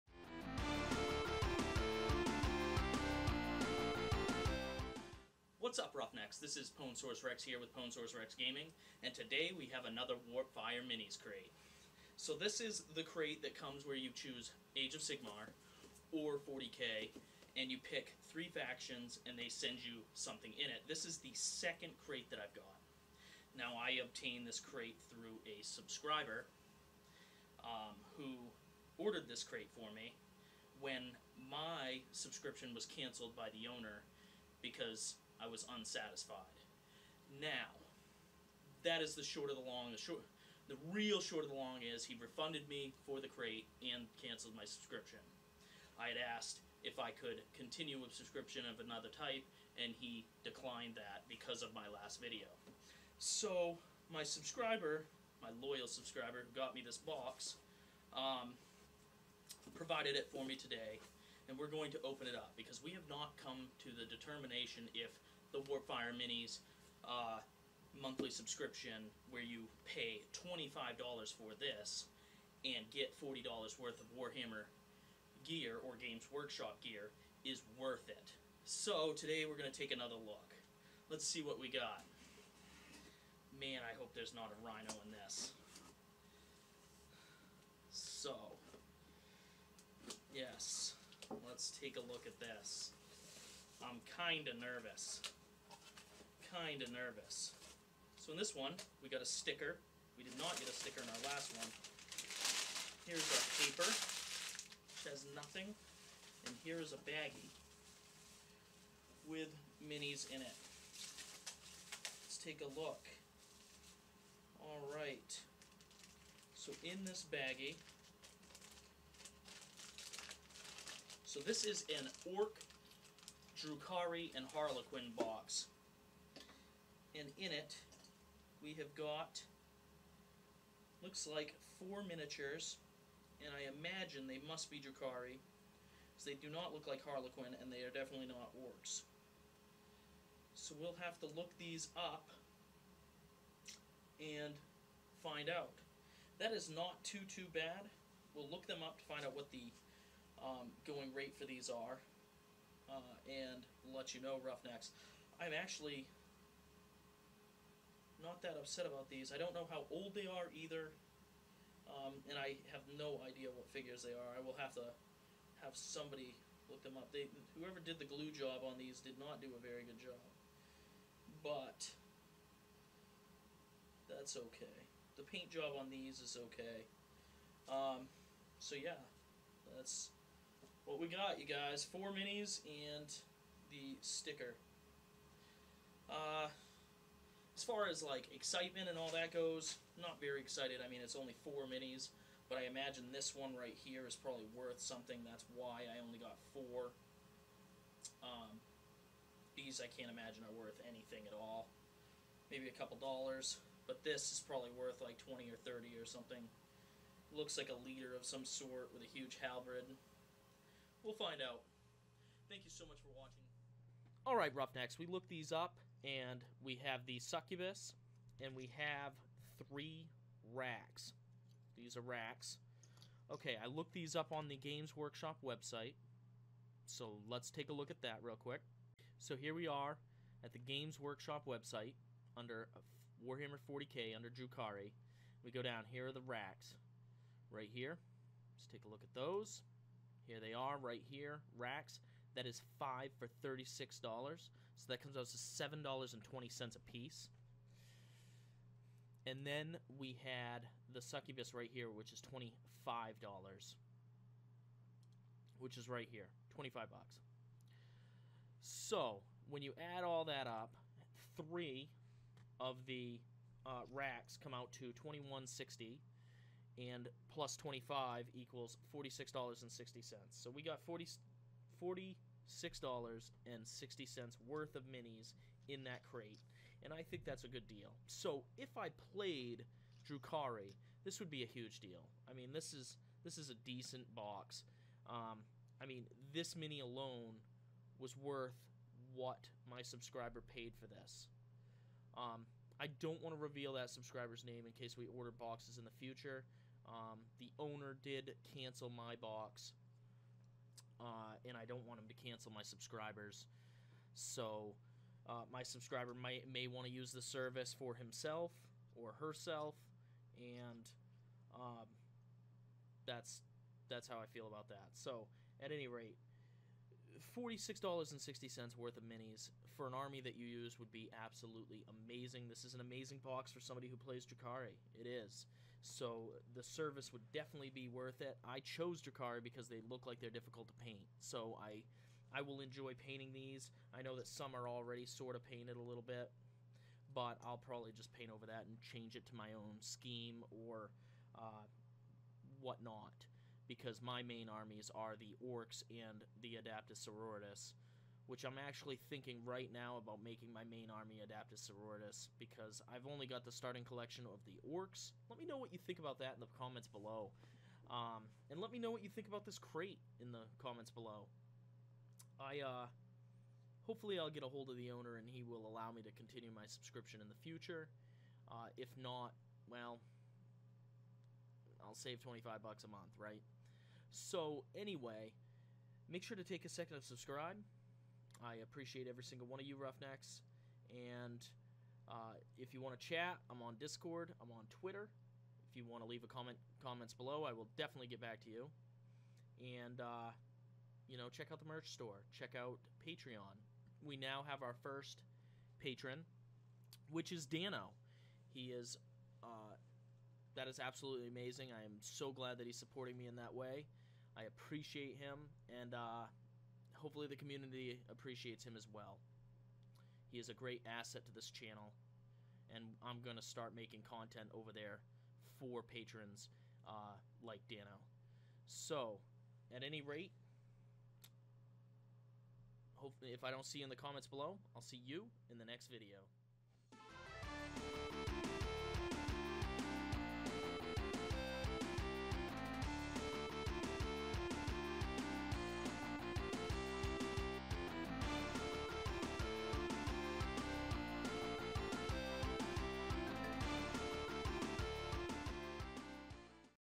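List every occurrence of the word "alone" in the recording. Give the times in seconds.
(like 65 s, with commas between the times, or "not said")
286 s.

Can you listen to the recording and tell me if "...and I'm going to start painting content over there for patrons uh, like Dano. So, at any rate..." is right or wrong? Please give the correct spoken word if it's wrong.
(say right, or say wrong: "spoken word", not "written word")
wrong: "making", not "painting".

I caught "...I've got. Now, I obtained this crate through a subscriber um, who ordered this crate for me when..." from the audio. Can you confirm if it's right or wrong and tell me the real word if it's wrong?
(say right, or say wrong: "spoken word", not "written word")
right.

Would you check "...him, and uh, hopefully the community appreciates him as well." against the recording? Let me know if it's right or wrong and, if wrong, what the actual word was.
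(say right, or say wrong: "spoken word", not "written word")
right.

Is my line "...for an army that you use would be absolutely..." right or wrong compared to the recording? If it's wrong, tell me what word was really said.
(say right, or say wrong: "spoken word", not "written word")
right.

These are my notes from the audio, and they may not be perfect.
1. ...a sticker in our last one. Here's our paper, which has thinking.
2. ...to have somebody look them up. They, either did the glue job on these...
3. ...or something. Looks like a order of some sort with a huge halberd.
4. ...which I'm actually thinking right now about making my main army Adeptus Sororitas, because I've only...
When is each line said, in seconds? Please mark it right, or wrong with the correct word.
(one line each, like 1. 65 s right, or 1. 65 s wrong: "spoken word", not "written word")
1. 100 s wrong: "nothing", not "thinking"
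2. 164 s wrong: "whoever", not "either"
3. 206 s wrong: "leader", not "order"
4. 348 s right.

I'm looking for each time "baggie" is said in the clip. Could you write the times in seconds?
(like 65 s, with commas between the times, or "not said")
107 s, 117 s.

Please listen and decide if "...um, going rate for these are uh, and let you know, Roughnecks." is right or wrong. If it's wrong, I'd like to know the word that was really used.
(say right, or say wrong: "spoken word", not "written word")
right.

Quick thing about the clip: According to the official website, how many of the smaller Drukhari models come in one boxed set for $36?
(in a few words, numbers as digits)
5.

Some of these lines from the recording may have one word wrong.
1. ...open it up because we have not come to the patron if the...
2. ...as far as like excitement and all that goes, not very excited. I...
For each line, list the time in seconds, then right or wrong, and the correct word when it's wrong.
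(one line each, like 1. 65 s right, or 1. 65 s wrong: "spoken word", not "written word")
1. 62 s wrong: "determination", not "patron"
2. 187 s right.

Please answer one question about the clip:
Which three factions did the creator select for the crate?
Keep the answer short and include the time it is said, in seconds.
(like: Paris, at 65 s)
Ork, Drukhari, and Harlequin, at 122 s.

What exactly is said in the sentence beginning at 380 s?
And uh, if you want to chat, I'm on Discord.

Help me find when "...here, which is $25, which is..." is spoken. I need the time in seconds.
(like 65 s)
251 s.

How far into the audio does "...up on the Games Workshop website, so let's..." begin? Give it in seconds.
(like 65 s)
224 s.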